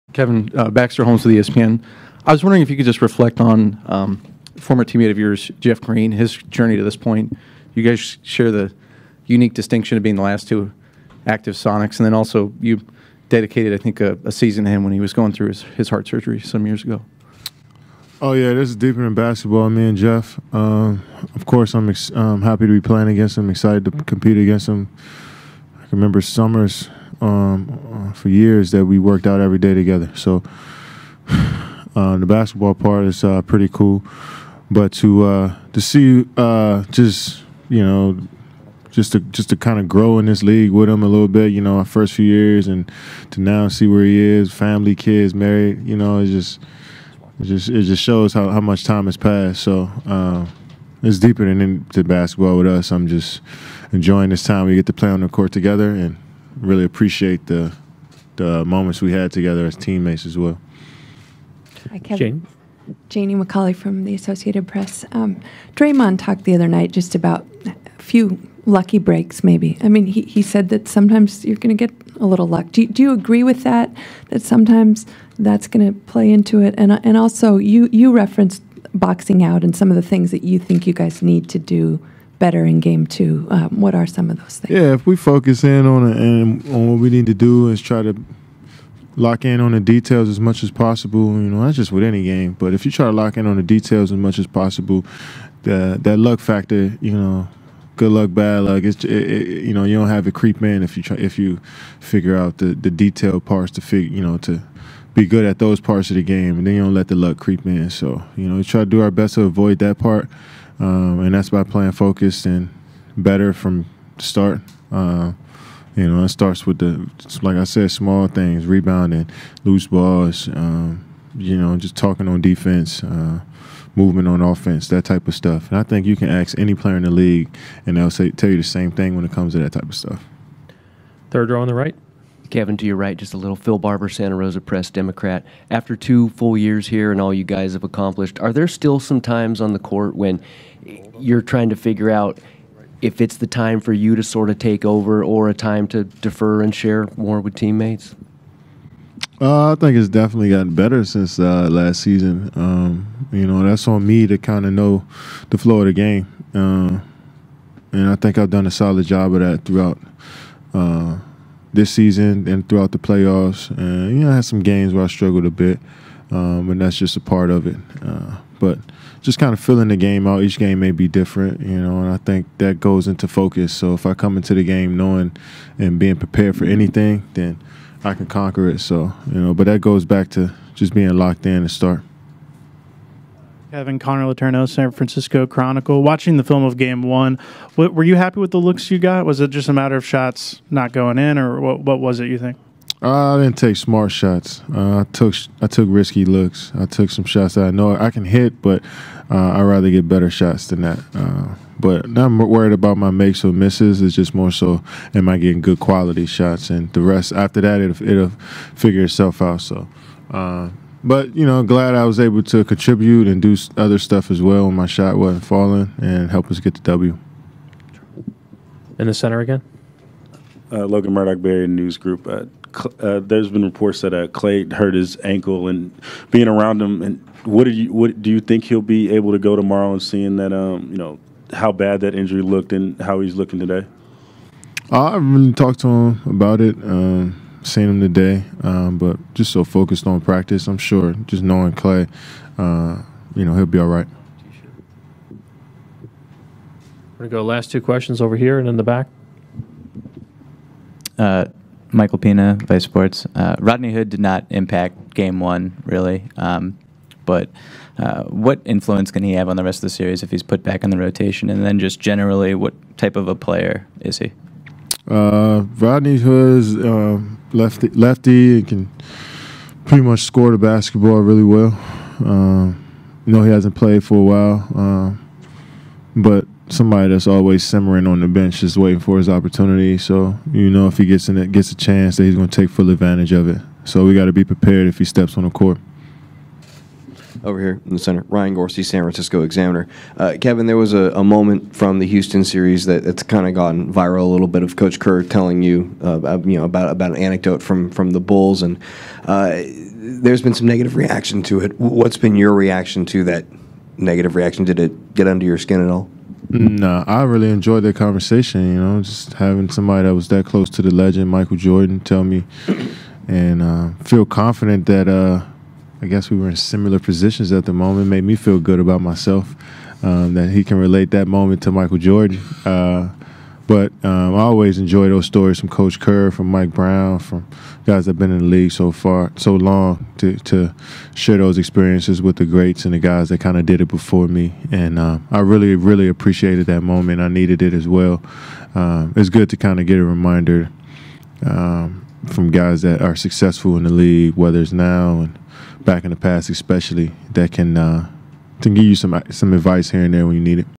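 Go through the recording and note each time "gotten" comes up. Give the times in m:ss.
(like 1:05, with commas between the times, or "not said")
2:30, 4:53.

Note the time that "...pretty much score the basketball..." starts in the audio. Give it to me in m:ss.
4:29.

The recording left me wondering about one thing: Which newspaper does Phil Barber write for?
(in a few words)
Santa Rosa Press Democrat.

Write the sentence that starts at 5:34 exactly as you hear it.
And uh, I really, really appreciated that moment.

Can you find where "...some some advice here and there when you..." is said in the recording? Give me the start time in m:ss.
5:48.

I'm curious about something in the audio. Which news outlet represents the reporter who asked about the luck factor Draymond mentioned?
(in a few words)
Associated Press.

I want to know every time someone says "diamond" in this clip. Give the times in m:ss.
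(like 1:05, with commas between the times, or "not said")
not said.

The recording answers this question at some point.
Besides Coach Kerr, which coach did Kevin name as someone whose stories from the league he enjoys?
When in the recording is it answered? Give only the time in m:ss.
5:26.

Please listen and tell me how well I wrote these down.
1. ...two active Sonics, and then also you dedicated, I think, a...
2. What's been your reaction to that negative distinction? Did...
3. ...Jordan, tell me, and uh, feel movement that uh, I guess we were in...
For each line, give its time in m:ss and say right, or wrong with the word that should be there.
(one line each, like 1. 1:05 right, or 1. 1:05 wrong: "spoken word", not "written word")
1. 0:10 right
2. 5:01 wrong: "reaction", not "distinction"
3. 5:11 wrong: "confident", not "movement".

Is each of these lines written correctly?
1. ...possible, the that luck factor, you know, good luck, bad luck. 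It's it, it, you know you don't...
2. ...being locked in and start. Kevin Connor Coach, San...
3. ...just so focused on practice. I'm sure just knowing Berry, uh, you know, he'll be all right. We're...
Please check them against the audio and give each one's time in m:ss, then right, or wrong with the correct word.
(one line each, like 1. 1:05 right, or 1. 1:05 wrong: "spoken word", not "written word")
1. 1:34 right
2. 3:00 wrong: "Letourneau", not "Coach"
3. 3:59 wrong: "Klay", not "Berry".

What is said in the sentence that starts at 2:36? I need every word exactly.
Uh, and I think I've done a solid job of that throughout uh, this season and throughout the playoffs.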